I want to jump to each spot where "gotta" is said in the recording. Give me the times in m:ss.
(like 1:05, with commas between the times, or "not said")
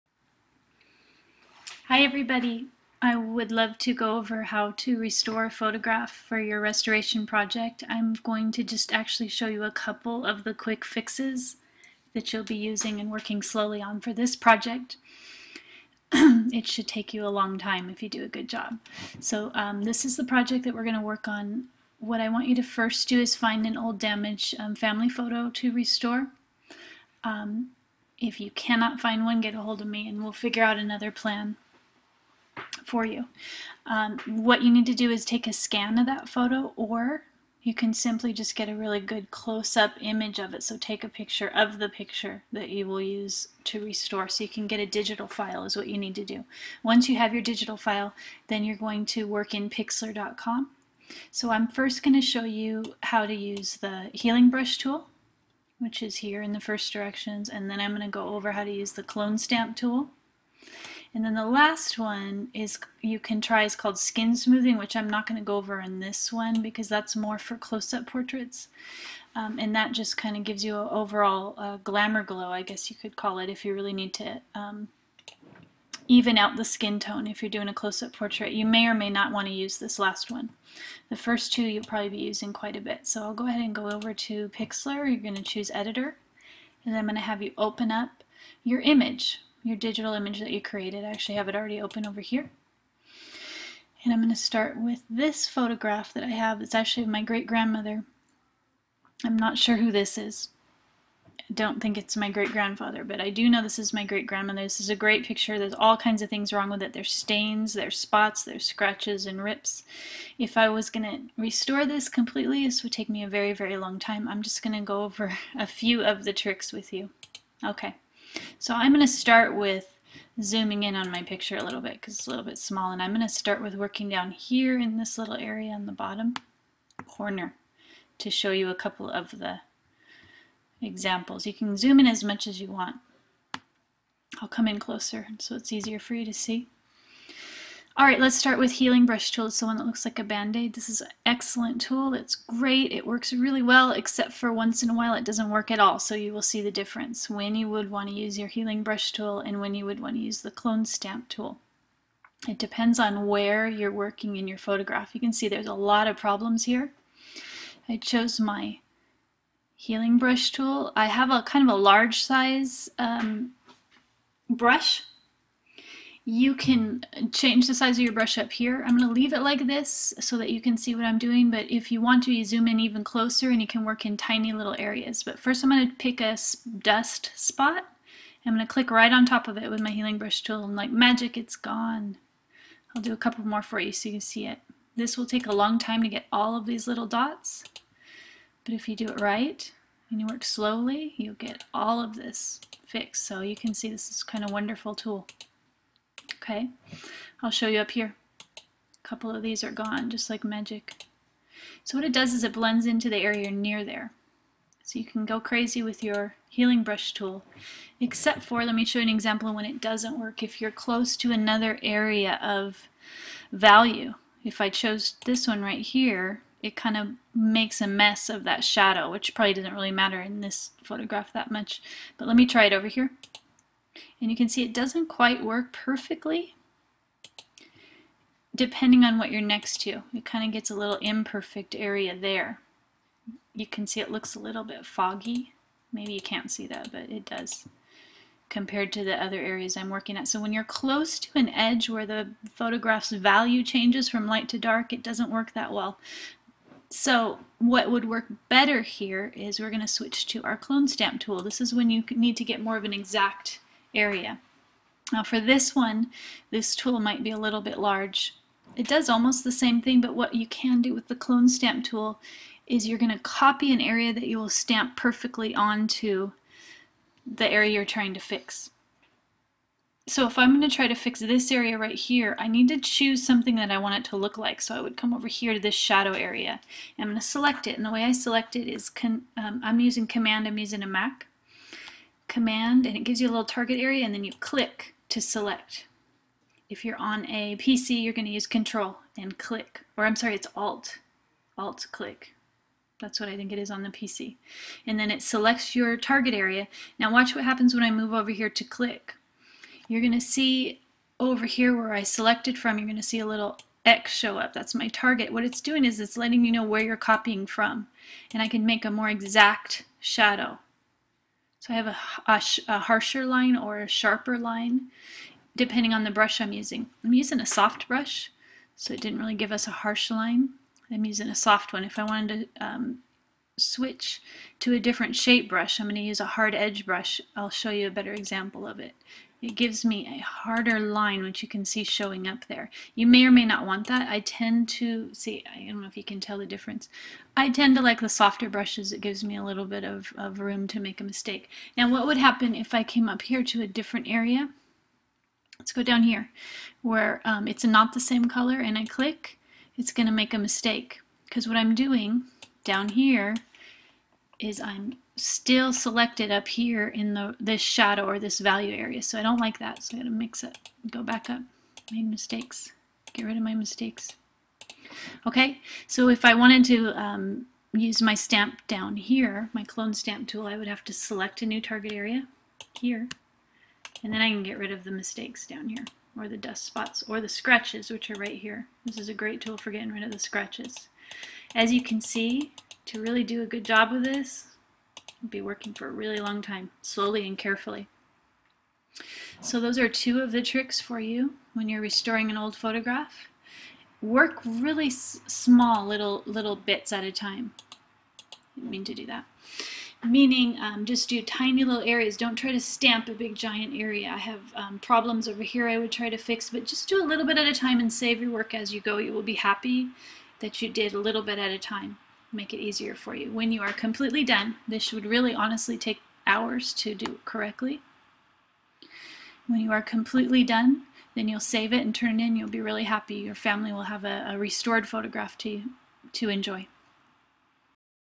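5:59.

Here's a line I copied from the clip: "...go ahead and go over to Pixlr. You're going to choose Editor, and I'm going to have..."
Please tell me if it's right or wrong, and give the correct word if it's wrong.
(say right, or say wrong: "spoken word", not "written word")
right.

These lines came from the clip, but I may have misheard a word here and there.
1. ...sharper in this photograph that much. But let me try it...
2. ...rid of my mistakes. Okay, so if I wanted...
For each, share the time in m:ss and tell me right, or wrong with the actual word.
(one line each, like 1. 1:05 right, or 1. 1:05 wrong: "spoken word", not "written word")
1. 3:39 wrong: "matter", not "sharper"
2. 6:03 right.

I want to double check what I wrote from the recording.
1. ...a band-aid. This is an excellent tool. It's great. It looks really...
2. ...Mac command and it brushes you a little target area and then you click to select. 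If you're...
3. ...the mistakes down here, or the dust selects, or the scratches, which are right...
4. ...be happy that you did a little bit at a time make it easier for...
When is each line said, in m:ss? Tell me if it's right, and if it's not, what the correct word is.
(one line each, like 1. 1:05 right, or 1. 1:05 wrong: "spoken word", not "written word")
1. 2:20 wrong: "works", not "looks"
2. 4:40 wrong: "gives", not "brushes"
3. 6:14 wrong: "spots", not "selects"
4. 6:49 right.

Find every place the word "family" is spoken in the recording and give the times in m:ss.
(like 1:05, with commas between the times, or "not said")
0:24, 7:03.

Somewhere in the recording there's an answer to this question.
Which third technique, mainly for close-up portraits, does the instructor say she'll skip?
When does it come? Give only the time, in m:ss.
1:03.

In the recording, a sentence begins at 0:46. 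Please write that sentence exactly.
Once you have your digital file, then you're going to work in pixlr.com.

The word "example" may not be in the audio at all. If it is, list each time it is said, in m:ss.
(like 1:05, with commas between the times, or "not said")
2:10, 3:29, 5:28.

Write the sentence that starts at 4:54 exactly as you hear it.
And then it selects your target area.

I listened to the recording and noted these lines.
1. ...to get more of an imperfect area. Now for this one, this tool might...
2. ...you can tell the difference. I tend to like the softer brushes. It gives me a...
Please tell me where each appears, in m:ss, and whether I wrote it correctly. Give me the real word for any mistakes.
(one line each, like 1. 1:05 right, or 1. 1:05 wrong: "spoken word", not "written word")
1. 4:12 wrong: "exact", not "imperfect"
2. 5:35 right.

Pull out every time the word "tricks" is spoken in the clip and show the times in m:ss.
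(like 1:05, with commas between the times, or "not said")
1:56, 6:30.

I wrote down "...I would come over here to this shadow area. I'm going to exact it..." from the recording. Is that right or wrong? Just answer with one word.
wrong.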